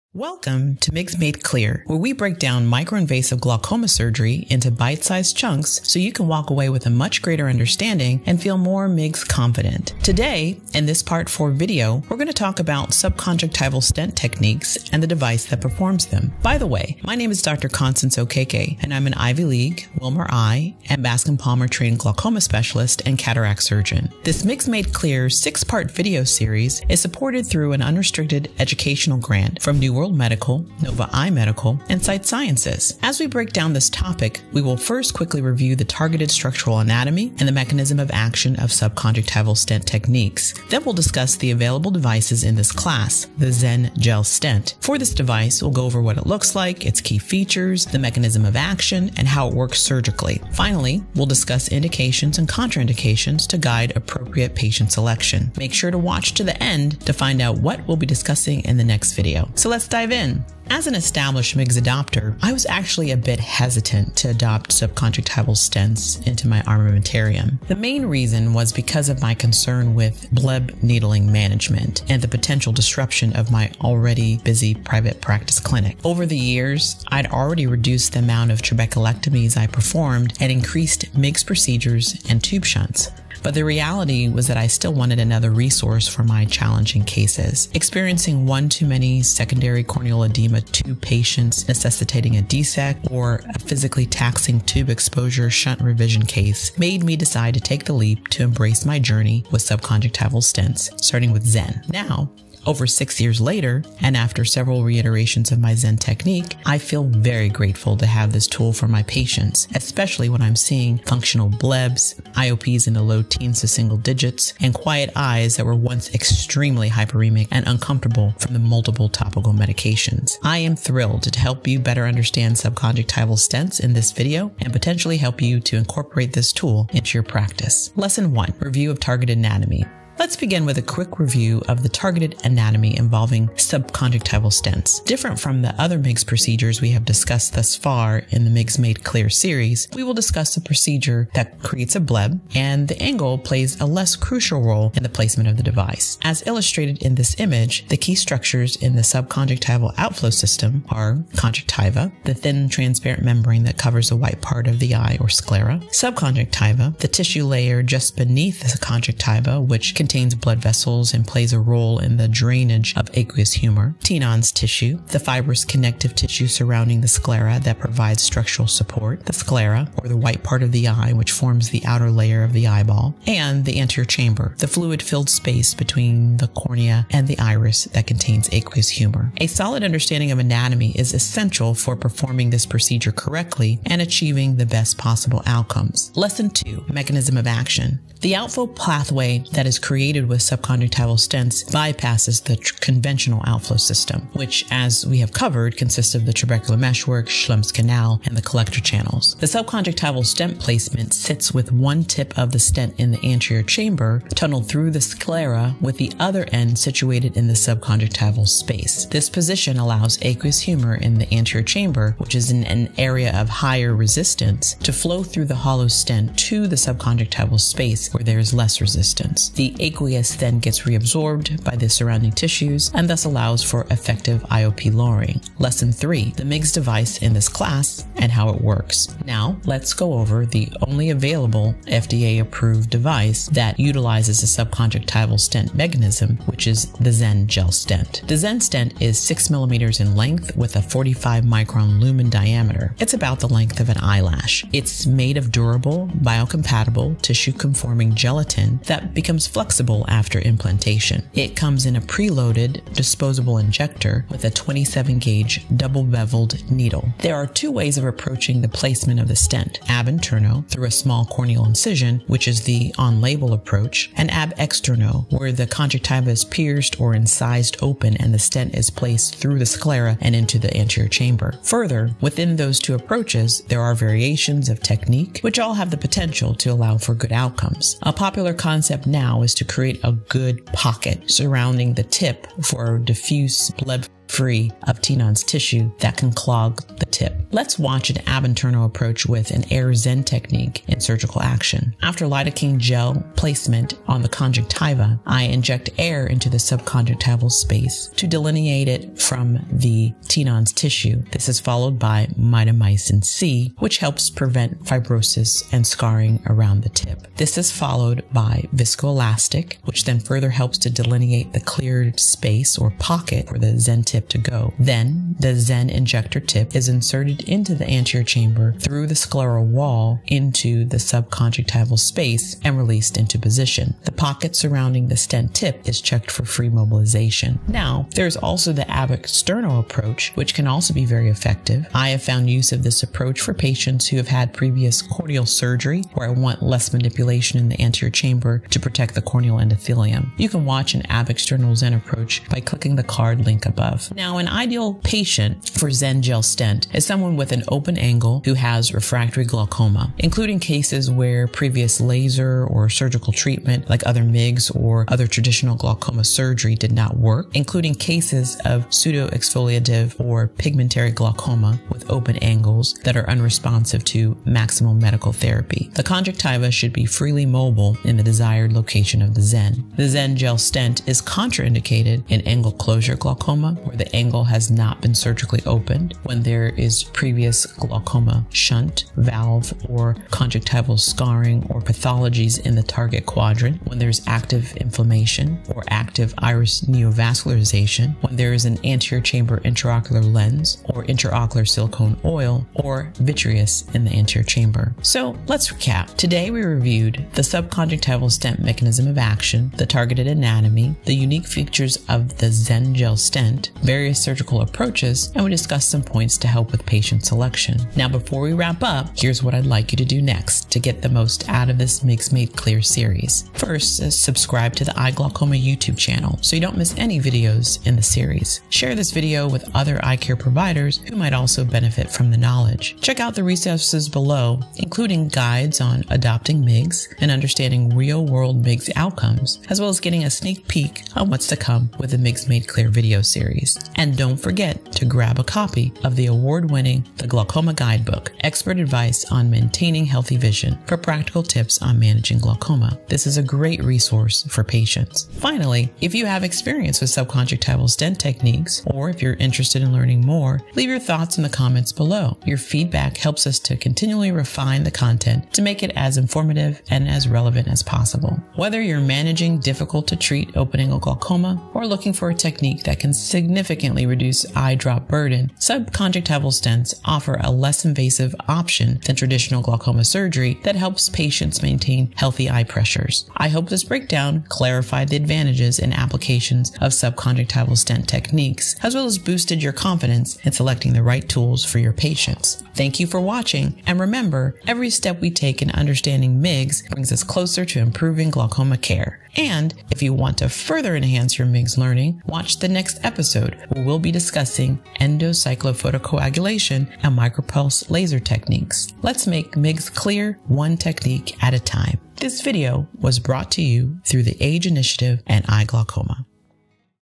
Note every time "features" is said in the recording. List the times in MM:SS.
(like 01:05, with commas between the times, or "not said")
00:47, 06:41.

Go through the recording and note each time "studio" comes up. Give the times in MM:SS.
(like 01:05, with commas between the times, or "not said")
not said.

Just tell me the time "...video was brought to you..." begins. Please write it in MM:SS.
08:22.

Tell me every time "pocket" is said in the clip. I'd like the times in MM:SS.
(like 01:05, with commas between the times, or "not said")
04:40, 05:12, 05:24.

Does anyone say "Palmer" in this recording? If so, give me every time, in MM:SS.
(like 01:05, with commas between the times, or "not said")
00:21.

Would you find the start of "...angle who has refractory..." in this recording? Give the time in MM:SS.
05:47.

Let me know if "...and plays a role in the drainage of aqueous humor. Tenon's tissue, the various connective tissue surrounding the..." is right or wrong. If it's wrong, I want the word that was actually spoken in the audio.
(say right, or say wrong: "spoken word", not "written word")
wrong: "fibrous", not "various".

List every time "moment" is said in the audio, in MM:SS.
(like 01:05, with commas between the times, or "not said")
not said.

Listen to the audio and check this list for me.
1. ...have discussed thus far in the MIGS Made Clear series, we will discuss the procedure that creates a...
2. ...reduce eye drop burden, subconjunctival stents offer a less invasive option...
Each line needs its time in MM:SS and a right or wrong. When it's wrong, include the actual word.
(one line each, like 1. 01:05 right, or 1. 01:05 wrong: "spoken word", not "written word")
1. 02:16 right
2. 07:44 right.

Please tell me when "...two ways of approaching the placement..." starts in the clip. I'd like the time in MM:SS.
04:17.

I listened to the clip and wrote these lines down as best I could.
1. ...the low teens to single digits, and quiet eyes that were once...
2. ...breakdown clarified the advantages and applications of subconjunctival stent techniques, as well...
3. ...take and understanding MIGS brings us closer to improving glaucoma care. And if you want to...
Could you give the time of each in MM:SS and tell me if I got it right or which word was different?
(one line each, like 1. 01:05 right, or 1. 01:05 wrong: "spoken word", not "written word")
1. 01:52 right
2. 07:53 right
3. 08:05 right.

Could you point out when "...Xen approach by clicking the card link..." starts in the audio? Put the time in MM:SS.
05:41.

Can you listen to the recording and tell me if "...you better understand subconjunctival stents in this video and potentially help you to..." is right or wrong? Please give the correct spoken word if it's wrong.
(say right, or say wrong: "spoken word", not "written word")
right.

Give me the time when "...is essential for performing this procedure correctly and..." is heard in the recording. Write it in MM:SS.
03:00.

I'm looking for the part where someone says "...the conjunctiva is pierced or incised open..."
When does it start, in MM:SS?
04:25.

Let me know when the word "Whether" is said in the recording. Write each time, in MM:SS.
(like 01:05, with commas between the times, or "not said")
07:38.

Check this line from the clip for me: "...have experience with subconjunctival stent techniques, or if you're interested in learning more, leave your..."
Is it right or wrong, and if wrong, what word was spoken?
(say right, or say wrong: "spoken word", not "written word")
right.